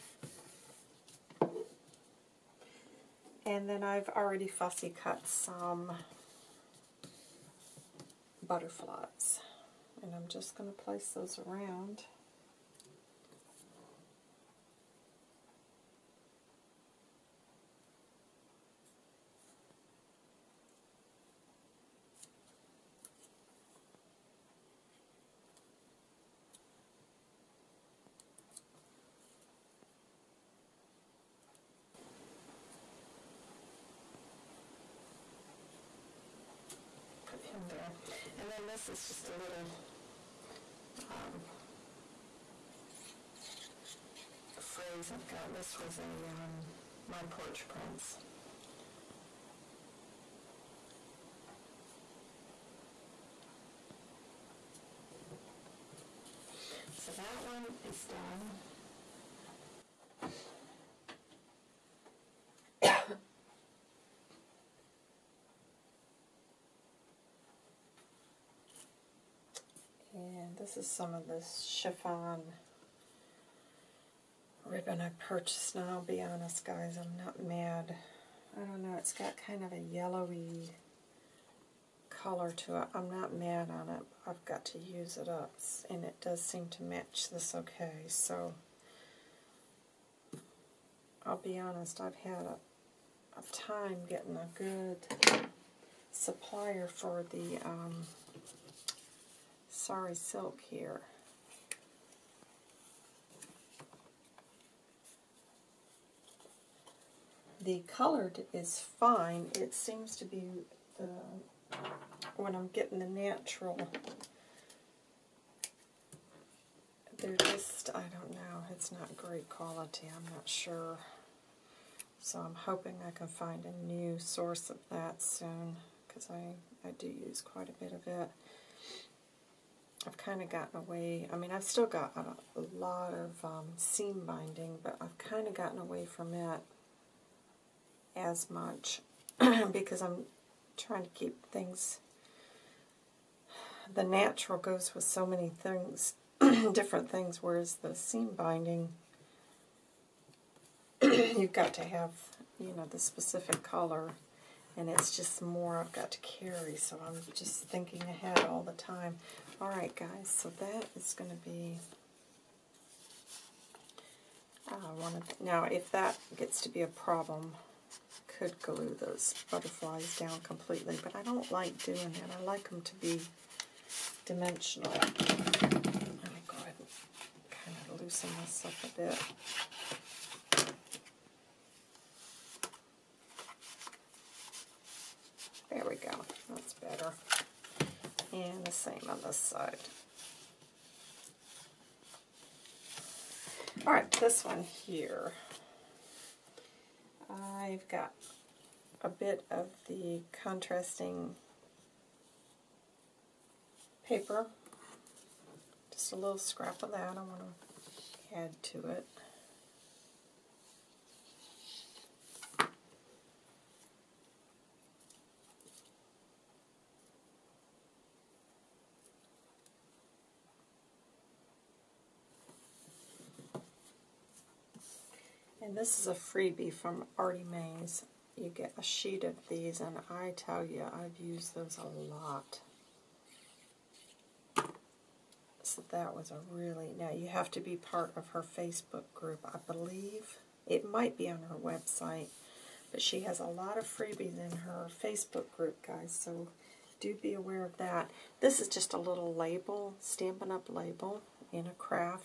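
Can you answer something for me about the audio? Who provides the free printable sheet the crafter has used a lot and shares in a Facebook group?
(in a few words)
Artie Mays.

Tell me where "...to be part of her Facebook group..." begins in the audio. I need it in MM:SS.
03:57.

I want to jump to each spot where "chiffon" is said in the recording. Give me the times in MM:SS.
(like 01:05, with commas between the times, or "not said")
01:11.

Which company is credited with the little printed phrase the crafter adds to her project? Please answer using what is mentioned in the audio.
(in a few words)
My Porch Prints.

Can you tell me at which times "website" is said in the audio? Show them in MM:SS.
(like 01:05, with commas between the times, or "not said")
04:01.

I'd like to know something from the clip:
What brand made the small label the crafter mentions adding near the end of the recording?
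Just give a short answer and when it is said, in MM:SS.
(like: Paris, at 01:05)
Stampin' Up!, at 04:10.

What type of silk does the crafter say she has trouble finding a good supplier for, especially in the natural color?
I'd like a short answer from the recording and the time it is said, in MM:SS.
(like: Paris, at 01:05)
Sari silk, at 01:39.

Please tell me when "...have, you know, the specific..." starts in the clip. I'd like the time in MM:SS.
02:31.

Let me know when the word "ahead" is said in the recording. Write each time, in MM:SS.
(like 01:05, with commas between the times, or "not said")
02:38, 02:56.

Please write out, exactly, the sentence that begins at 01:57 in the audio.
They're just, I don't know, it's not great quality.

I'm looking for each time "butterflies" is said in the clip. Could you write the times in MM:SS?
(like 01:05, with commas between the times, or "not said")
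00:08, 02:49.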